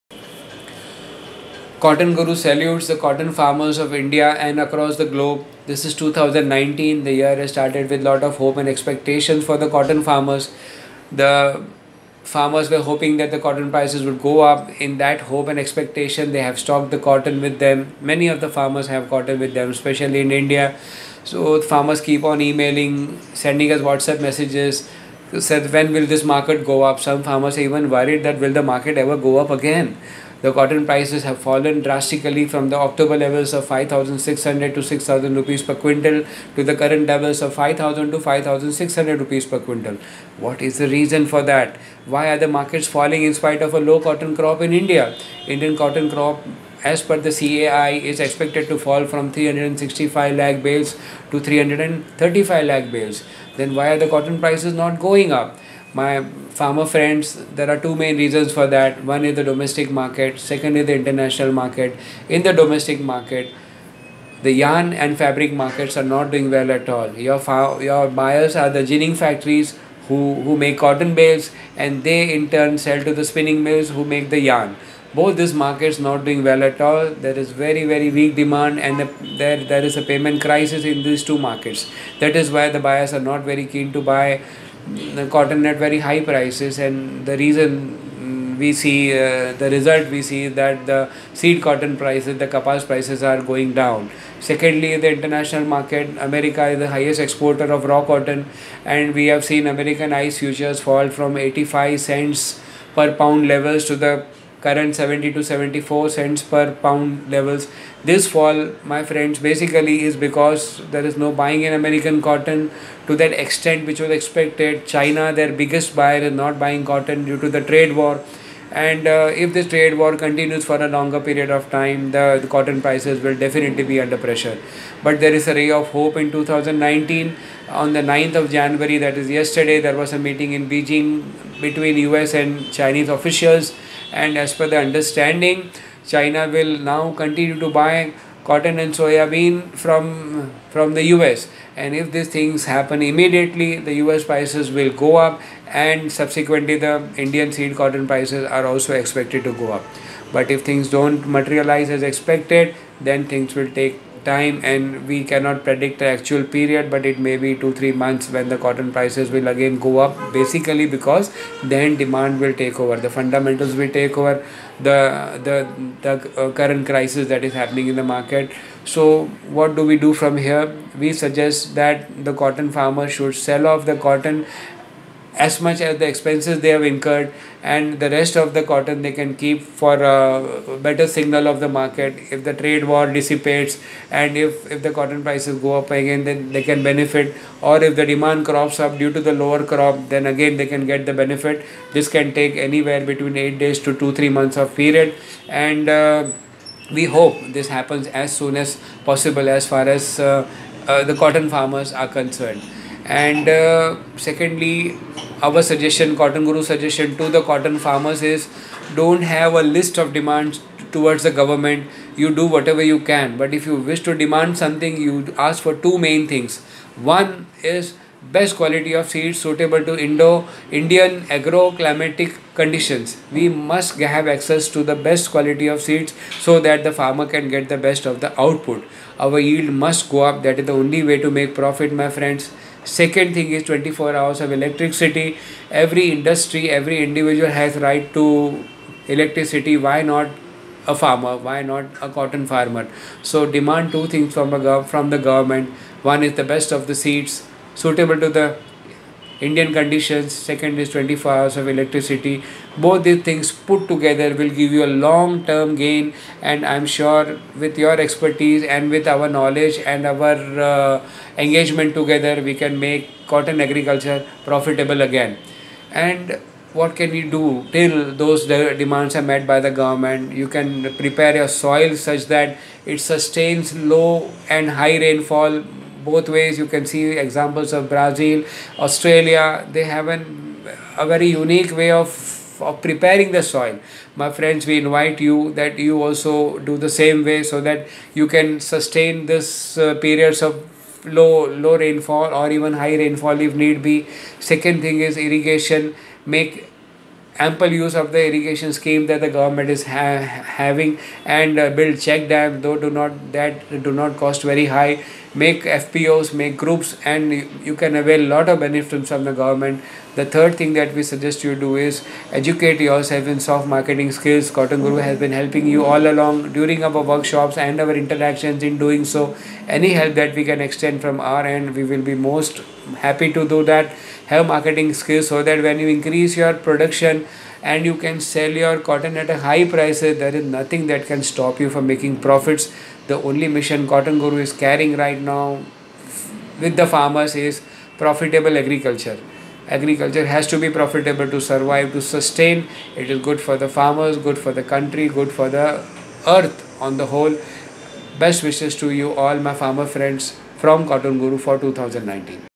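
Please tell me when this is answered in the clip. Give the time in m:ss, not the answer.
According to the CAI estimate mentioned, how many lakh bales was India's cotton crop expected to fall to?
0:51.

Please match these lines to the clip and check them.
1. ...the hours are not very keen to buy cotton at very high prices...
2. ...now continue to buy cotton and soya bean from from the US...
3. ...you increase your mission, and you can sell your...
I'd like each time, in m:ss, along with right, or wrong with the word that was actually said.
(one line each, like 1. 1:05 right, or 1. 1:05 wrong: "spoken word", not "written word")
1. 1:22 wrong: "buyers", not "hours"
2. 2:16 right
3. 5:25 wrong: "production", not "mission".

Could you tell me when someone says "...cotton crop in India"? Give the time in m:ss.
0:43.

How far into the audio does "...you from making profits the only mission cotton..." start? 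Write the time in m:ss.
5:31.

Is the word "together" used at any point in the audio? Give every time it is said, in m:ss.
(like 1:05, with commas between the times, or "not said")
4:13, 4:21.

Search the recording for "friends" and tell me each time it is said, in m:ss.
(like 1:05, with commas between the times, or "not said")
0:56, 1:49, 3:52, 4:44, 5:49.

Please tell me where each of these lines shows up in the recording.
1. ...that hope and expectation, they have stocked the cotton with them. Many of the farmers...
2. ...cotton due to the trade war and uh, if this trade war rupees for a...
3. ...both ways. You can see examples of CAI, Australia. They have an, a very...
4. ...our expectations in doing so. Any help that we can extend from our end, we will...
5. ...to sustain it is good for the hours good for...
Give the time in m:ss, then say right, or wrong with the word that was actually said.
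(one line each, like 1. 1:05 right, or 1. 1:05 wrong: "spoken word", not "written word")
1. 0:14 right
2. 1:56 wrong: "continues", not "rupees"
3. 4:36 wrong: "Brazil", not "CAI"
4. 5:17 wrong: "interactions", not "expectations"
5. 5:41 wrong: "farmers", not "hours".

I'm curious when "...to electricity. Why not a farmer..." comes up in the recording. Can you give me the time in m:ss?
3:58.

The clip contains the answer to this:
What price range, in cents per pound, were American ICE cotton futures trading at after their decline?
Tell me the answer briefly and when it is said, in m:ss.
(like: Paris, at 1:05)
70 to 74 cents per pound, at 1:44.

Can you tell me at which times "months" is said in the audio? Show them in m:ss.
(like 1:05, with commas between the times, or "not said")
2:37, 3:14.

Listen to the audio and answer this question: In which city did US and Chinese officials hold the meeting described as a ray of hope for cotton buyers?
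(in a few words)
Beijing.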